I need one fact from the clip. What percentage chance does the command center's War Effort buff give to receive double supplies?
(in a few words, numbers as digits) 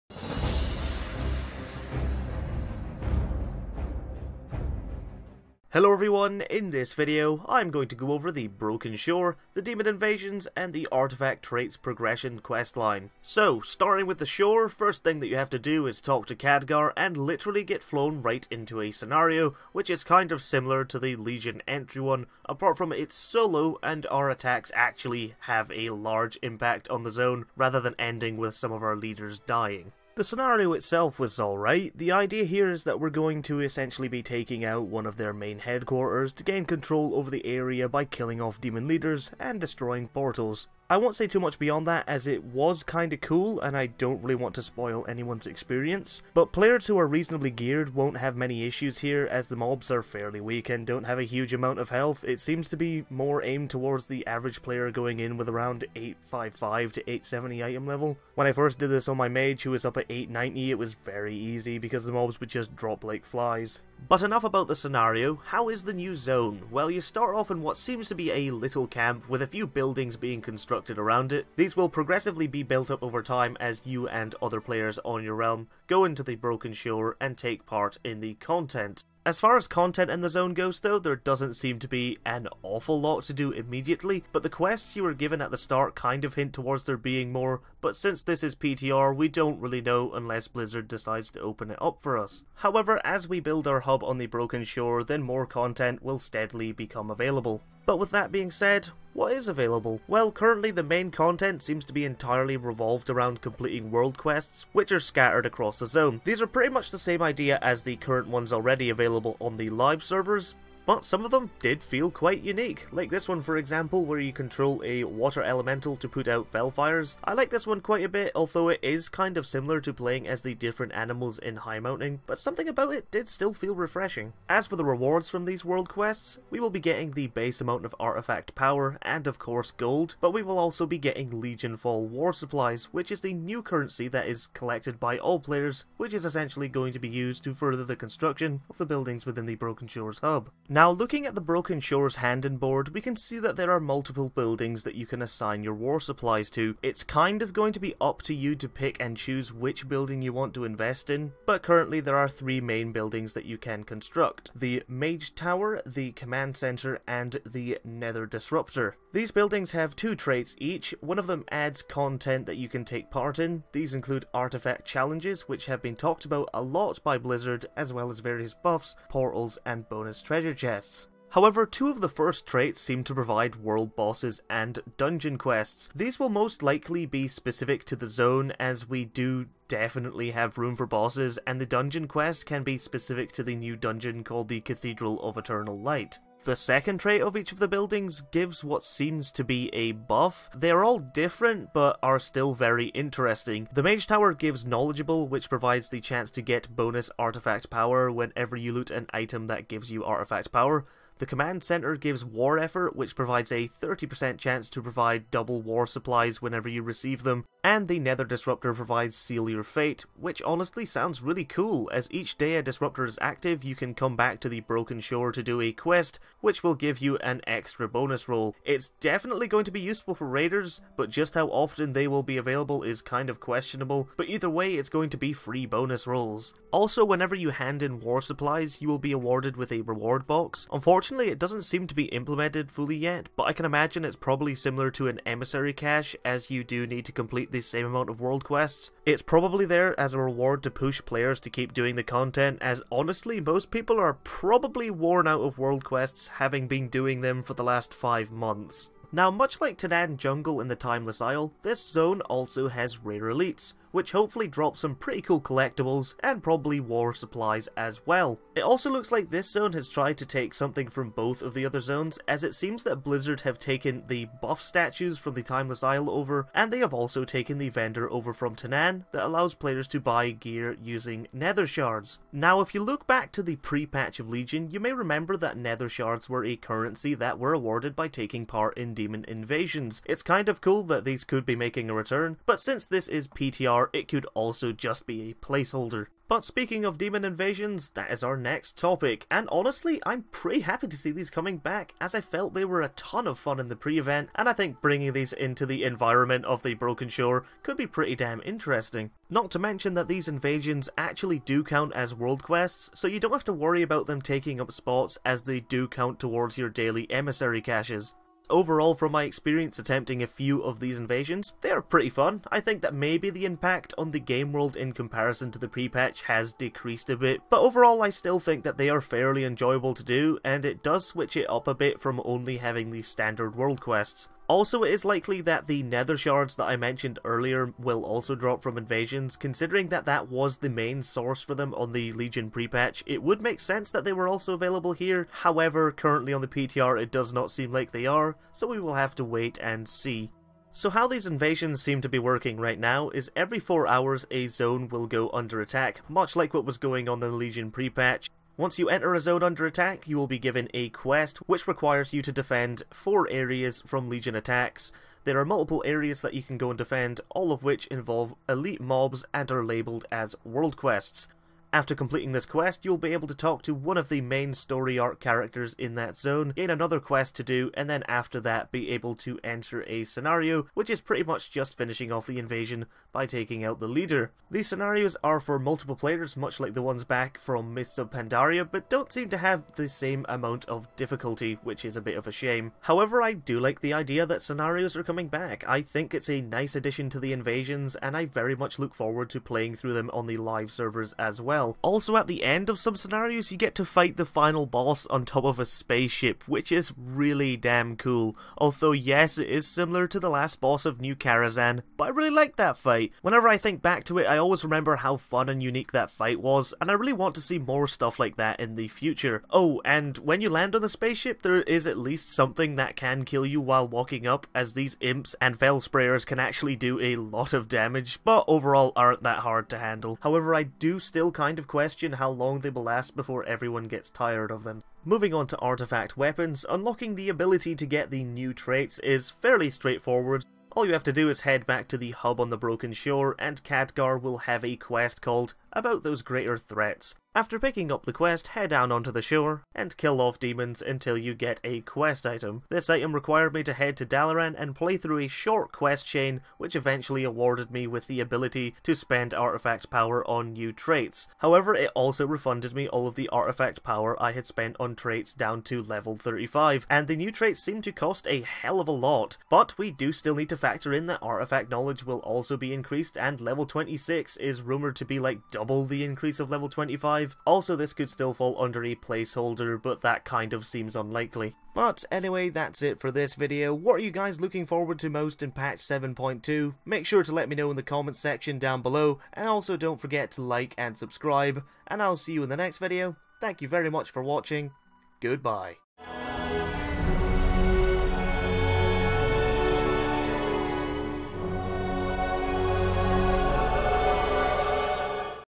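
30%.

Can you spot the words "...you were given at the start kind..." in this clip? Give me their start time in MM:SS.
01:24.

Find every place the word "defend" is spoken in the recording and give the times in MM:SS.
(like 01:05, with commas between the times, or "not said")
05:52, 05:56.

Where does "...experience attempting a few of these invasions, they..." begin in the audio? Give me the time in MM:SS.
05:09.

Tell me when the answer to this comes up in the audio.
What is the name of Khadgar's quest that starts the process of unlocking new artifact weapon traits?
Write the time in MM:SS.
07:15.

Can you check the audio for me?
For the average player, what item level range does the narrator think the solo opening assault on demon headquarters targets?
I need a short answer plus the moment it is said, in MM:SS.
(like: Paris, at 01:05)
855 to 870, at 00:55.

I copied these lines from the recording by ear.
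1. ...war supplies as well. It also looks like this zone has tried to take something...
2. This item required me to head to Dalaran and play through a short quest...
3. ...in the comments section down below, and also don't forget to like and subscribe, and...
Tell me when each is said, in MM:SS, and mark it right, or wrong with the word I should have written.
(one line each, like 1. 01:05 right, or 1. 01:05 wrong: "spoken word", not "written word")
1. 04:16 right
2. 07:22 right
3. 07:57 right.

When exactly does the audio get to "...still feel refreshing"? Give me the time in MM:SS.
02:03.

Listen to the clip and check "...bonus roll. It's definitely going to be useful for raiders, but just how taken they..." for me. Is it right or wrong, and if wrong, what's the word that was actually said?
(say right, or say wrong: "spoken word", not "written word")
wrong: "often", not "taken".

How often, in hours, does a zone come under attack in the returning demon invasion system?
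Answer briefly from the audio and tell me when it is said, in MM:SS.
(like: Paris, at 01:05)
4, at 05:43.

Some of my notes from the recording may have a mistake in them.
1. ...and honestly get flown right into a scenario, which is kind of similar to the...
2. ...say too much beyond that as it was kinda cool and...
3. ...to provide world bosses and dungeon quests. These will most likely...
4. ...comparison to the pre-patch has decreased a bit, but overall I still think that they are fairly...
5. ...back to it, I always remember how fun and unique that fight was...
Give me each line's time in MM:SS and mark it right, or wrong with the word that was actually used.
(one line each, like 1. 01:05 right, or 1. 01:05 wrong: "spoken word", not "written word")
1. 00:16 wrong: "literally", not "honestly"
2. 00:41 right
3. 02:53 right
4. 05:14 right
5. 06:43 right.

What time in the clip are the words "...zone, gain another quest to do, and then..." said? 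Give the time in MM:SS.
06:06.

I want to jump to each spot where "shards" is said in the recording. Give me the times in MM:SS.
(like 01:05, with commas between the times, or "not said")
04:31, 04:35, 05:26.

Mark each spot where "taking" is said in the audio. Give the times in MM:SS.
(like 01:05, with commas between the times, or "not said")
00:34, 04:38, 05:04, 06:13.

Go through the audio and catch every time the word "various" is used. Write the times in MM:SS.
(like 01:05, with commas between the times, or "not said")
02:48.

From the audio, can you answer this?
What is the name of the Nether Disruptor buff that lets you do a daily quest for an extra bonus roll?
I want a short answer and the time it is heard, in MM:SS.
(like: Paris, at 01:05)
Seal Your Fate, at 03:29.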